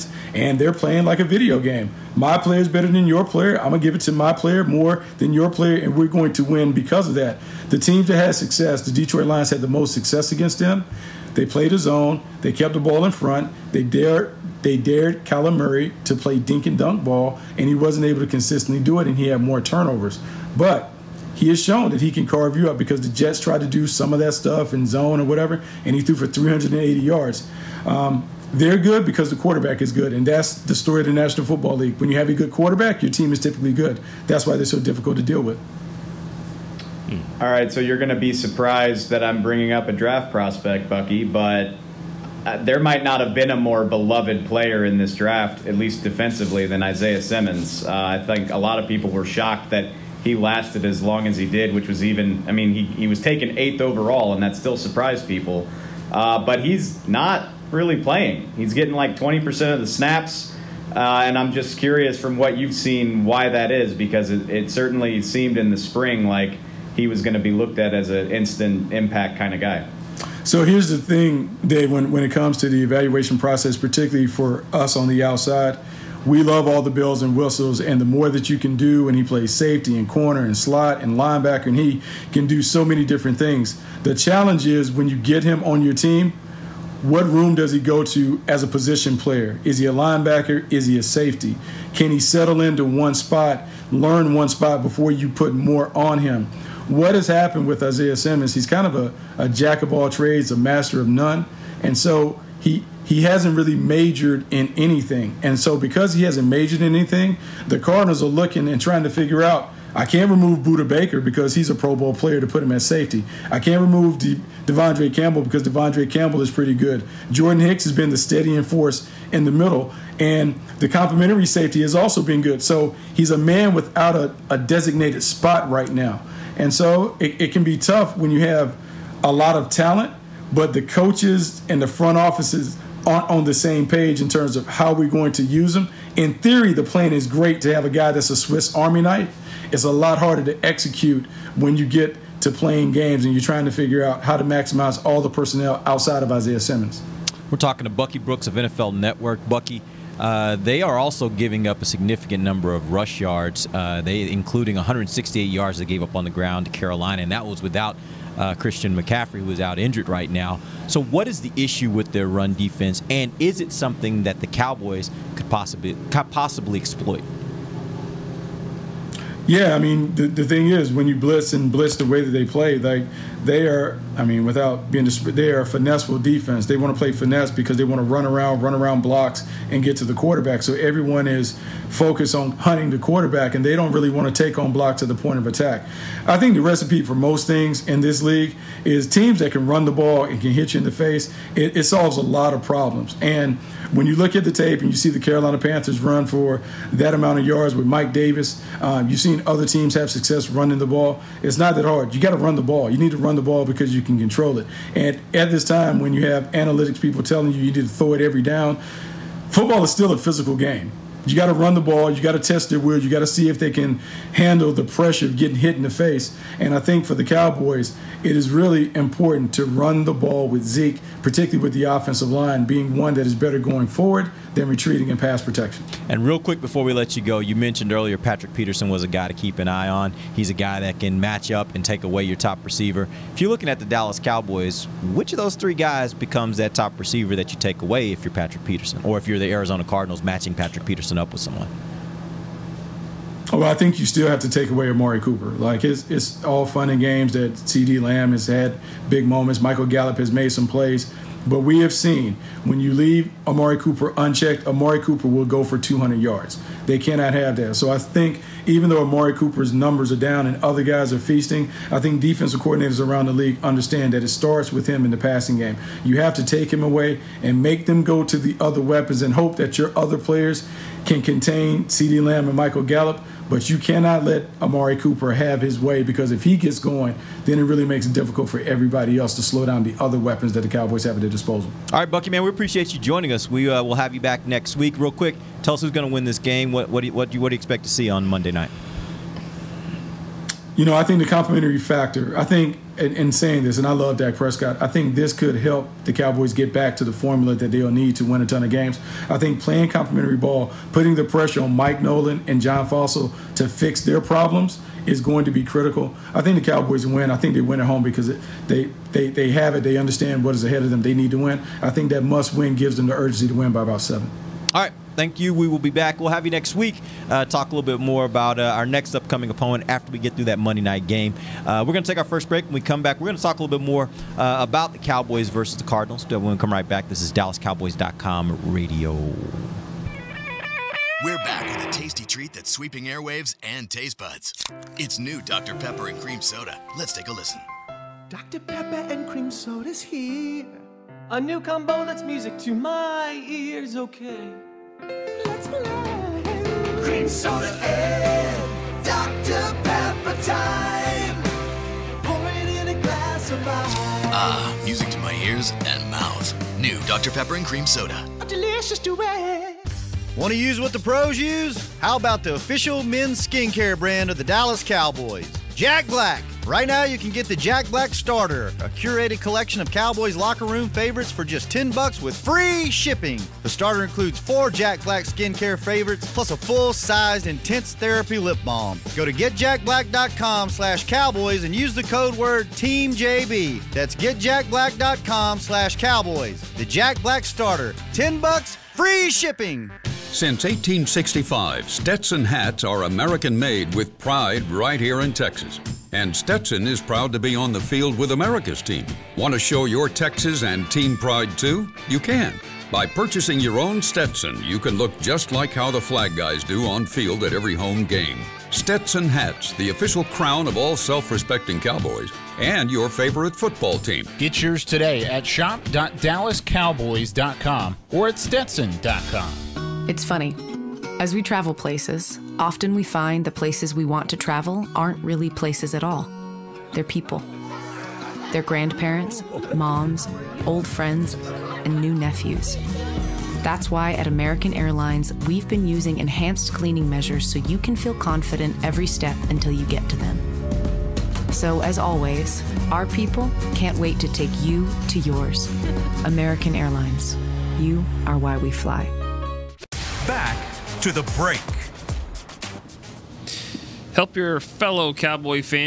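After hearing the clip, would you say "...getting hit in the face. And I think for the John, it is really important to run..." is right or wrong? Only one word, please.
wrong.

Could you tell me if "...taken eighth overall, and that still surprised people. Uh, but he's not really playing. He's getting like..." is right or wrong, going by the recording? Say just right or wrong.
right.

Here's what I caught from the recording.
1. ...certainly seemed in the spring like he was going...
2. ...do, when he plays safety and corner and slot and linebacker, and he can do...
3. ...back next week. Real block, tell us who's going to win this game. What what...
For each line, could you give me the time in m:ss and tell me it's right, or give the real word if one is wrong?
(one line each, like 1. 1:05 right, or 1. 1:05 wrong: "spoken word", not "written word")
1. 1:04 right
2. 1:18 right
3. 4:44 wrong: "quick", not "block".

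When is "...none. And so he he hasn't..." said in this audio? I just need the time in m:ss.
1:41.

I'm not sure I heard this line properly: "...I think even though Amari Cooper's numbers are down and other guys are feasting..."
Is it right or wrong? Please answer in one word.
right.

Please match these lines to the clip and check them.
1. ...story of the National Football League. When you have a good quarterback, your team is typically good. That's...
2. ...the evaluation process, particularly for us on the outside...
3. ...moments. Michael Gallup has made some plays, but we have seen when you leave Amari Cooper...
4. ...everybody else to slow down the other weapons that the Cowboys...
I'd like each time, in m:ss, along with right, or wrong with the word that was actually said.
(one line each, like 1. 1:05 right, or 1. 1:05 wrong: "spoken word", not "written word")
1. 0:30 right
2. 1:12 right
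3. 4:09 right
4. 4:38 right.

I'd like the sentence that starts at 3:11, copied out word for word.
It, it solves a lot of problems.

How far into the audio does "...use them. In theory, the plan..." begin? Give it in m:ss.
2:15.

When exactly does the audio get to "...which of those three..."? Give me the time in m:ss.
3:55.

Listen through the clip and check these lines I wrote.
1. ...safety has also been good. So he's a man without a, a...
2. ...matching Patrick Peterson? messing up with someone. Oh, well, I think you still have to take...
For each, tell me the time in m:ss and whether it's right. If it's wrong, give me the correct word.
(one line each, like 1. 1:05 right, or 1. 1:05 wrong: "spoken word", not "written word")
1. 2:01 right
2. 4:00 right.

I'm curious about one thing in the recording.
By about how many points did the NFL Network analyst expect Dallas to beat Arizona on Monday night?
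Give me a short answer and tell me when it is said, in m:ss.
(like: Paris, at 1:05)
7, at 5:14.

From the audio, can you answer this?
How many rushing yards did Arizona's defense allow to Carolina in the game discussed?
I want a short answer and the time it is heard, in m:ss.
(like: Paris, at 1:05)
168, at 2:34.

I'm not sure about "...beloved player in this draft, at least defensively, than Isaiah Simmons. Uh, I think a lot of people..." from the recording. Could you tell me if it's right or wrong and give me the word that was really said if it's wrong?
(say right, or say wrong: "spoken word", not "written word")
right.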